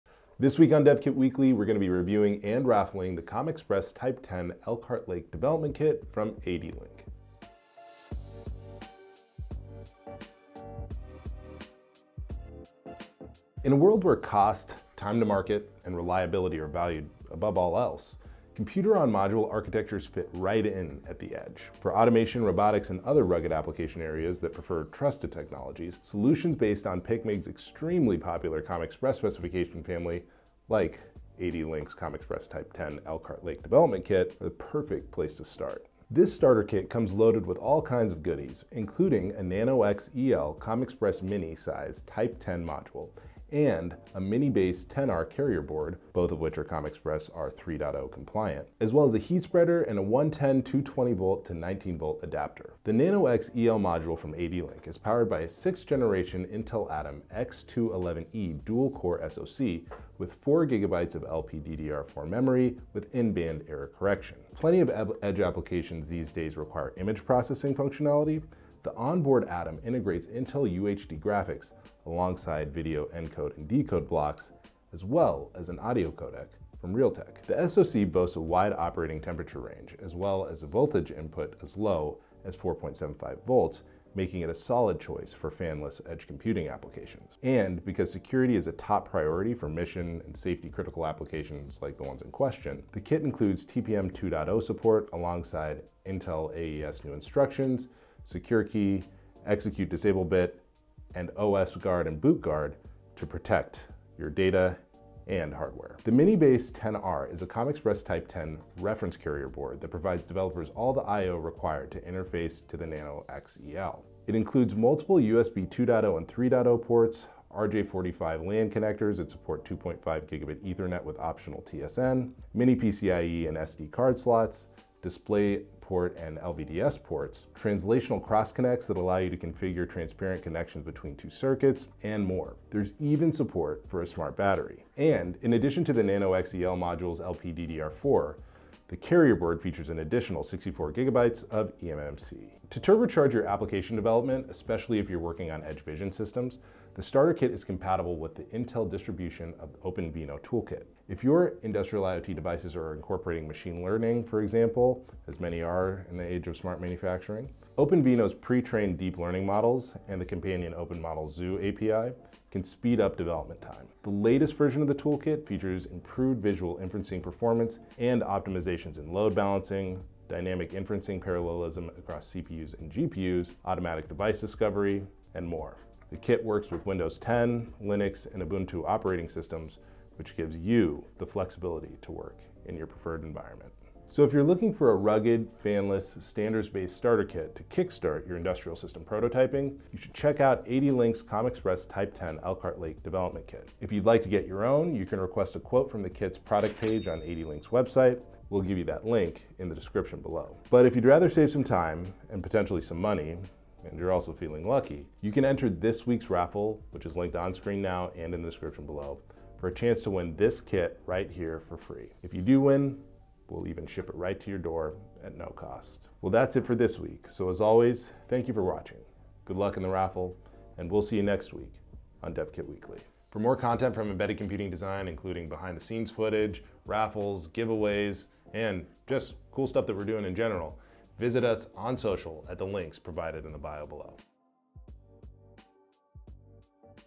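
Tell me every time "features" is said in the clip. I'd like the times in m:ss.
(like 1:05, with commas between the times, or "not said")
2:19, 2:45.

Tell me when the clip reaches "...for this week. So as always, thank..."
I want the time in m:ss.
3:36.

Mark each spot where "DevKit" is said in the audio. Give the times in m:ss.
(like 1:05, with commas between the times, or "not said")
0:00, 3:42.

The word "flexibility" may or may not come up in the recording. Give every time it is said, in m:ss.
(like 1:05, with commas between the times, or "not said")
3:01.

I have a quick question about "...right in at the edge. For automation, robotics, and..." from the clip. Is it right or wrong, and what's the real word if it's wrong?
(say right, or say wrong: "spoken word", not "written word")
right.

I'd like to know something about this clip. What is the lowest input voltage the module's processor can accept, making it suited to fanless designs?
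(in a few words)
4.75 volts.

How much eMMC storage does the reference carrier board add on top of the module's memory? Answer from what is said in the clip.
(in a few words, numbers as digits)
64 gigabytes.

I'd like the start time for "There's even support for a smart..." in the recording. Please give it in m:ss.
2:12.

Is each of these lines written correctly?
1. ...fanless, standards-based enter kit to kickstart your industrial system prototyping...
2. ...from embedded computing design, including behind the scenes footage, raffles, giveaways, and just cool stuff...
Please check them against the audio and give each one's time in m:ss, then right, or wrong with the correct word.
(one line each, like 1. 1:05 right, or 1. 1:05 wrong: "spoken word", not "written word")
1. 3:05 wrong: "starter", not "enter"
2. 3:43 right.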